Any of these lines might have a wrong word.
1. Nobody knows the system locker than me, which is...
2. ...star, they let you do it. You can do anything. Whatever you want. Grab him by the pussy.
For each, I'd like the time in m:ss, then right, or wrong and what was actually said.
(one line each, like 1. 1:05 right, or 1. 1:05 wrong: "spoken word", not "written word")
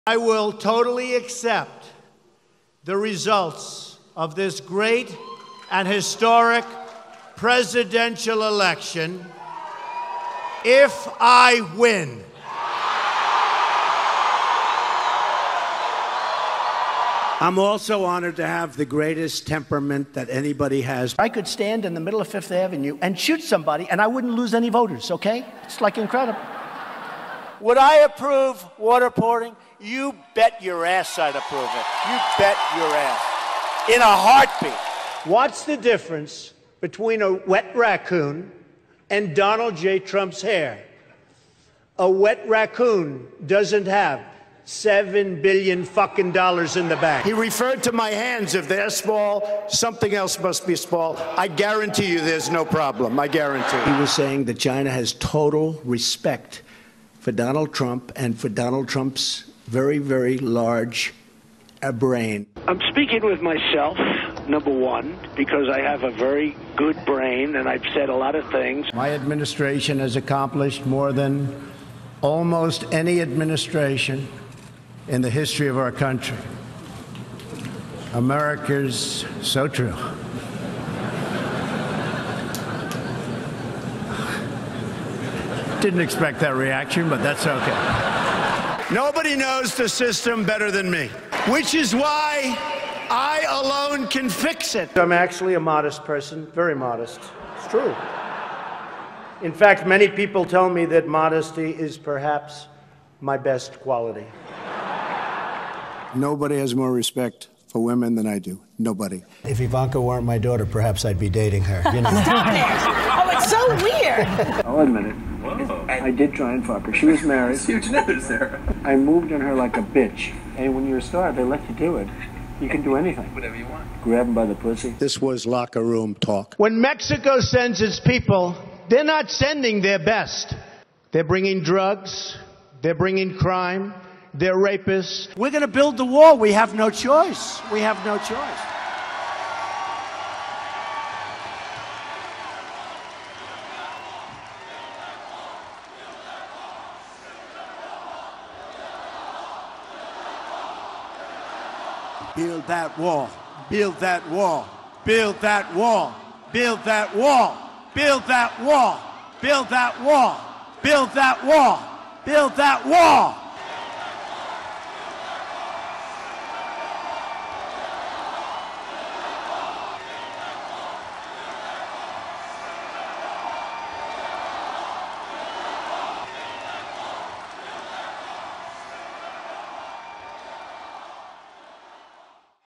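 1. 1:28 wrong: "better", not "locker"
2. 2:01 right.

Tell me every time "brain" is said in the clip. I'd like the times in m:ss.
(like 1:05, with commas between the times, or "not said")
1:01, 1:07.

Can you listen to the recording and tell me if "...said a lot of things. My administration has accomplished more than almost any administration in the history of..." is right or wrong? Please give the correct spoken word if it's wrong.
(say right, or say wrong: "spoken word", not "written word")
right.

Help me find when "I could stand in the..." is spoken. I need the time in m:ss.
0:21.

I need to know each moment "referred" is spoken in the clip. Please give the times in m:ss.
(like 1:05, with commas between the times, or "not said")
0:47.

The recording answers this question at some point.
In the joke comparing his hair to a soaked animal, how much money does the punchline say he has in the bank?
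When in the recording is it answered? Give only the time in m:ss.
0:44.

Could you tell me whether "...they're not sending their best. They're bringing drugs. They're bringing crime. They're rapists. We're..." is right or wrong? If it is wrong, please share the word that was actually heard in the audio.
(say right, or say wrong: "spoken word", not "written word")
right.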